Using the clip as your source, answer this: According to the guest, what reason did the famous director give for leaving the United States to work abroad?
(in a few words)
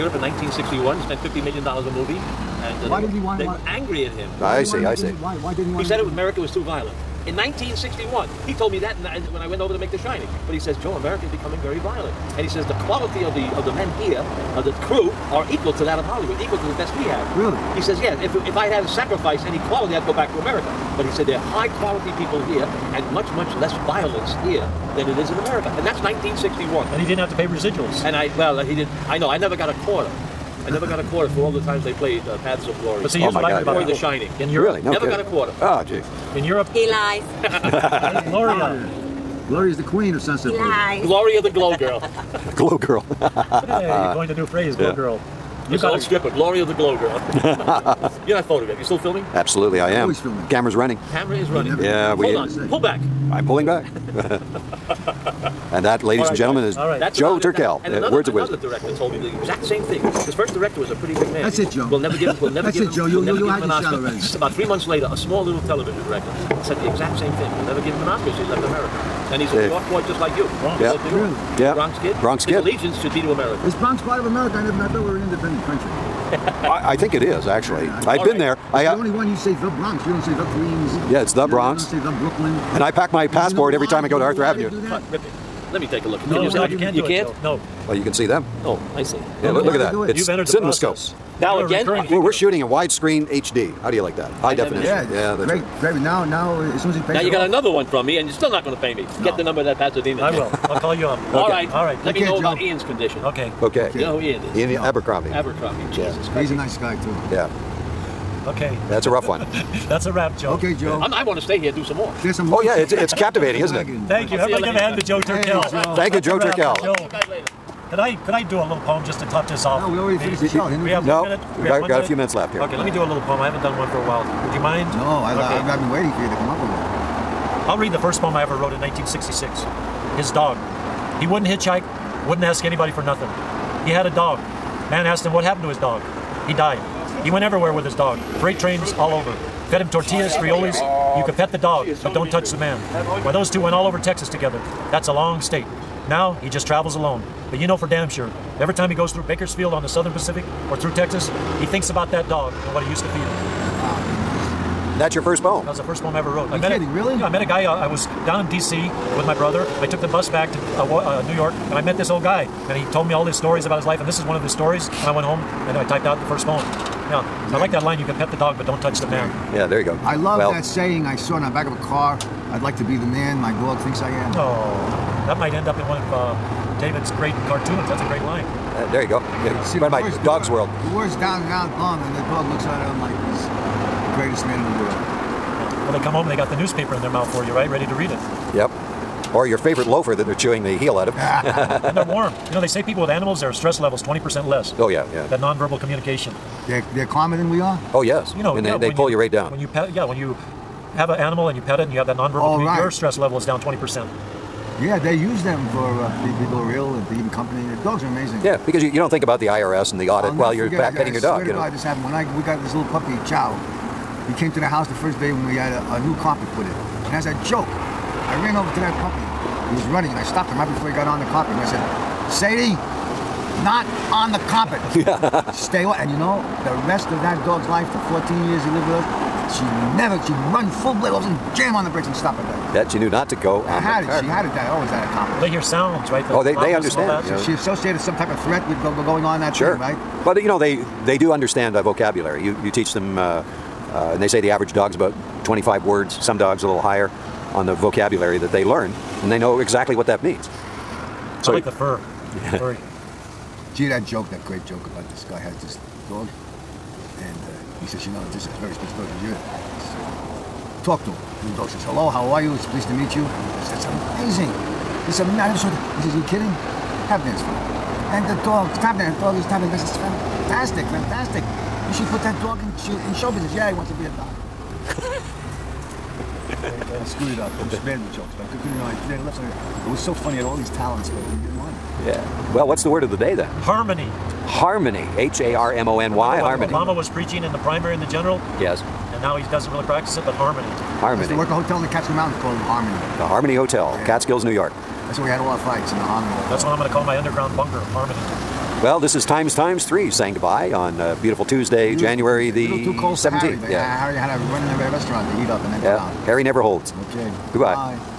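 America was too violent.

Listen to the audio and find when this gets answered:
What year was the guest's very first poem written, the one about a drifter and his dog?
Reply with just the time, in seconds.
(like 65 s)
128 s.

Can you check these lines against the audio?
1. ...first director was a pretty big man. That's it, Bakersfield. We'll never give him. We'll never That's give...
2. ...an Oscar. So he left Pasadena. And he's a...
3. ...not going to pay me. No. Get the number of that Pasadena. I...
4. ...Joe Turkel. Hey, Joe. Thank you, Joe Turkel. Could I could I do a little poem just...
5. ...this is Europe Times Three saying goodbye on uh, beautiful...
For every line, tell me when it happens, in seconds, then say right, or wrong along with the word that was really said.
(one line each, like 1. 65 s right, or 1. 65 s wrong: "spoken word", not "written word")
1. 60 s wrong: "Joe", not "Bakersfield"
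2. 68 s wrong: "America", not "Pasadena"
3. 98 s right
4. 115 s right
5. 298 s wrong: "Times", not "Europe".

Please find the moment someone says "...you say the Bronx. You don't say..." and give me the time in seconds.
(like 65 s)
79 s.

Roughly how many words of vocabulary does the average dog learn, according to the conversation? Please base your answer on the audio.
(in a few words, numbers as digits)
25.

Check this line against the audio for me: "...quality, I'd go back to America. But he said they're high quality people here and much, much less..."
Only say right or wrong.
right.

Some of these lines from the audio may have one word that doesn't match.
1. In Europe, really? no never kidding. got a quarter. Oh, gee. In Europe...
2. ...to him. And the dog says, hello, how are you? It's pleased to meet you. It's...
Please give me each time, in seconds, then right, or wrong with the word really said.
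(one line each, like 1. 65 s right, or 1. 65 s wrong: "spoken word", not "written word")
1. 34 s right
2. 261 s right.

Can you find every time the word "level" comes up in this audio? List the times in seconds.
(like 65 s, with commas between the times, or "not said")
193 s, 203 s.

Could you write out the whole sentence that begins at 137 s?
He went everywhere with his dog, freight trains all over.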